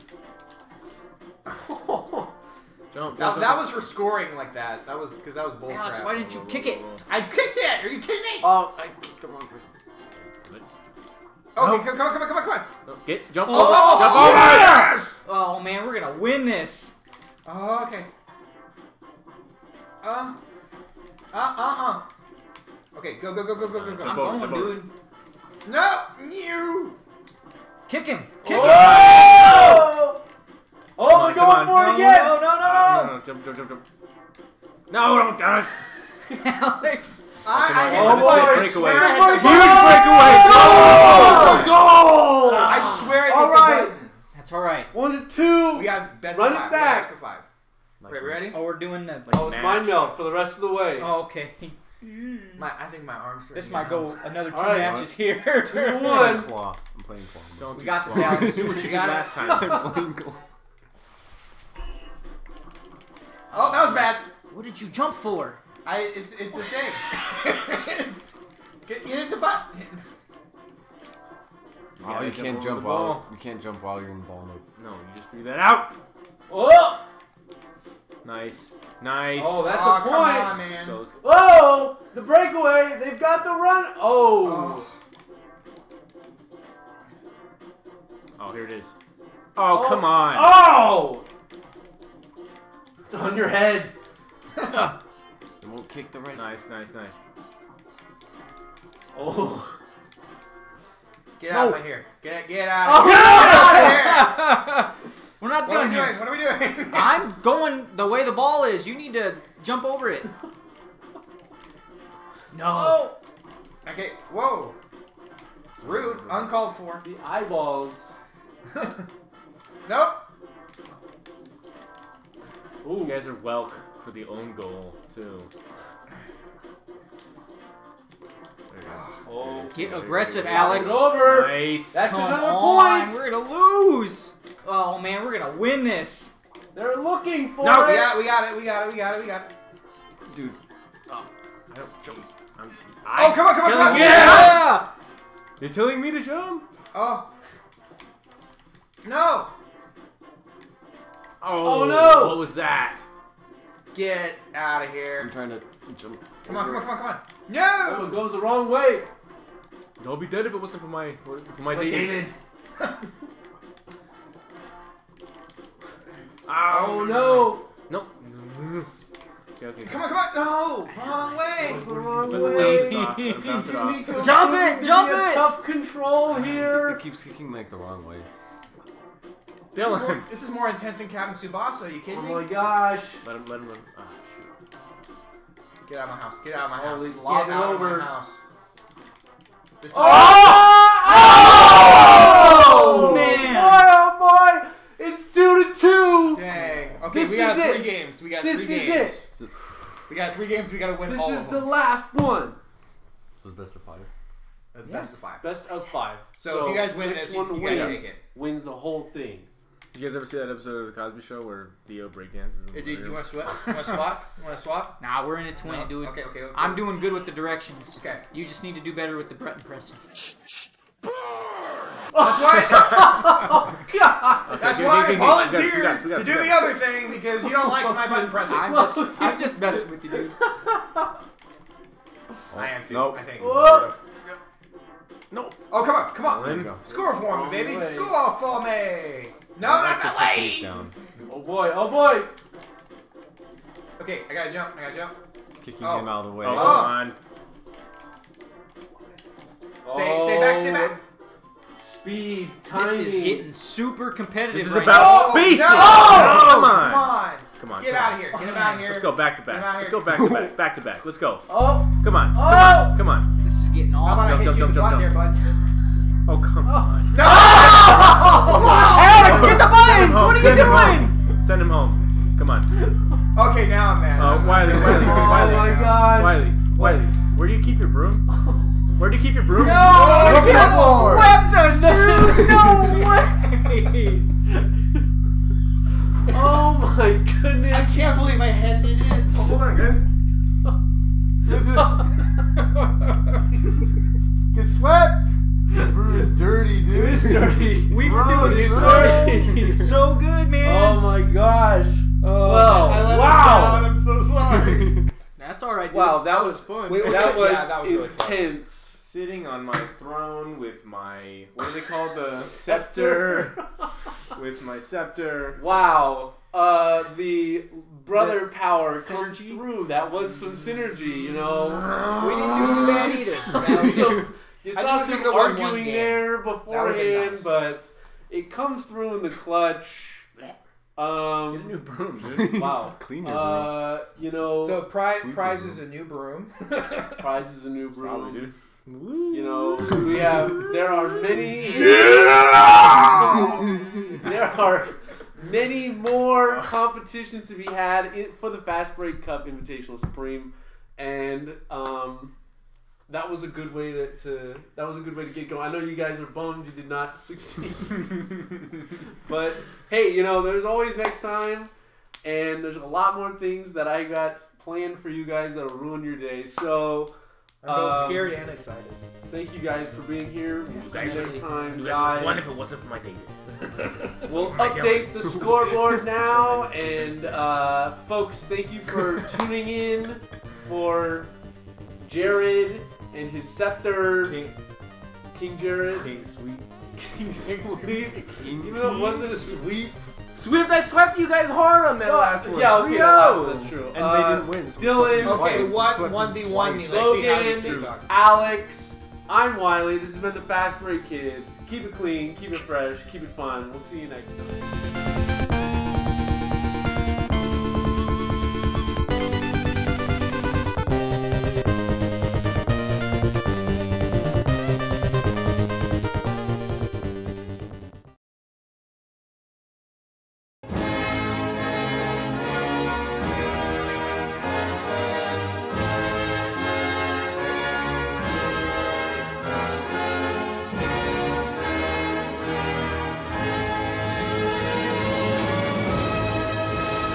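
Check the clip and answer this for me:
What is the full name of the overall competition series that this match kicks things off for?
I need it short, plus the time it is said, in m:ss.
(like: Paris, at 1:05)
Fastbreak Cup Invitational Supreme, at 5:48.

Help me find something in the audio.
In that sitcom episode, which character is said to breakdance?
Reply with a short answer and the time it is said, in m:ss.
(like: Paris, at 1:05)
Theo, at 3:31.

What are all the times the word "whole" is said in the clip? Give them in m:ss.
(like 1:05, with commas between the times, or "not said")
3:28.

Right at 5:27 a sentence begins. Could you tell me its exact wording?
but it comes through in the clutch.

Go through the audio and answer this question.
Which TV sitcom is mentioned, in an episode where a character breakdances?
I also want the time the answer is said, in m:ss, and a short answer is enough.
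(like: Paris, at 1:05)
The Cosby Show, at 3:30.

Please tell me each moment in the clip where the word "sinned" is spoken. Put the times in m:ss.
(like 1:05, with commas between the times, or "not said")
not said.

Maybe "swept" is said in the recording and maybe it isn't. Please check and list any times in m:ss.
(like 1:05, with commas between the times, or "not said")
4:41, 4:54, 6:30.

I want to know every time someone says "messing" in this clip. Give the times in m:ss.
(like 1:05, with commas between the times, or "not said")
3:49.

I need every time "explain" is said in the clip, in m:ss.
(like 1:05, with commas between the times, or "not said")
not said.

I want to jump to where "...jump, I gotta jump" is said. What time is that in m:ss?
4:04.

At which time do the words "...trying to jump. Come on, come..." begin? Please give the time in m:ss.
2:35.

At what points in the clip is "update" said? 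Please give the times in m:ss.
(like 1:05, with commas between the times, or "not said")
6:14.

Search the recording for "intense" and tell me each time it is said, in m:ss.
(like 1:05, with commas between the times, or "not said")
3:00, 5:08.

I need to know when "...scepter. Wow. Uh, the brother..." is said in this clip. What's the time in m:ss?
5:14.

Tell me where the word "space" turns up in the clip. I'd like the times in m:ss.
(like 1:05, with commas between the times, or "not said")
4:15.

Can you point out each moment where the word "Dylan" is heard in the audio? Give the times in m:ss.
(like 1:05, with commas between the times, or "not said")
2:59, 6:34.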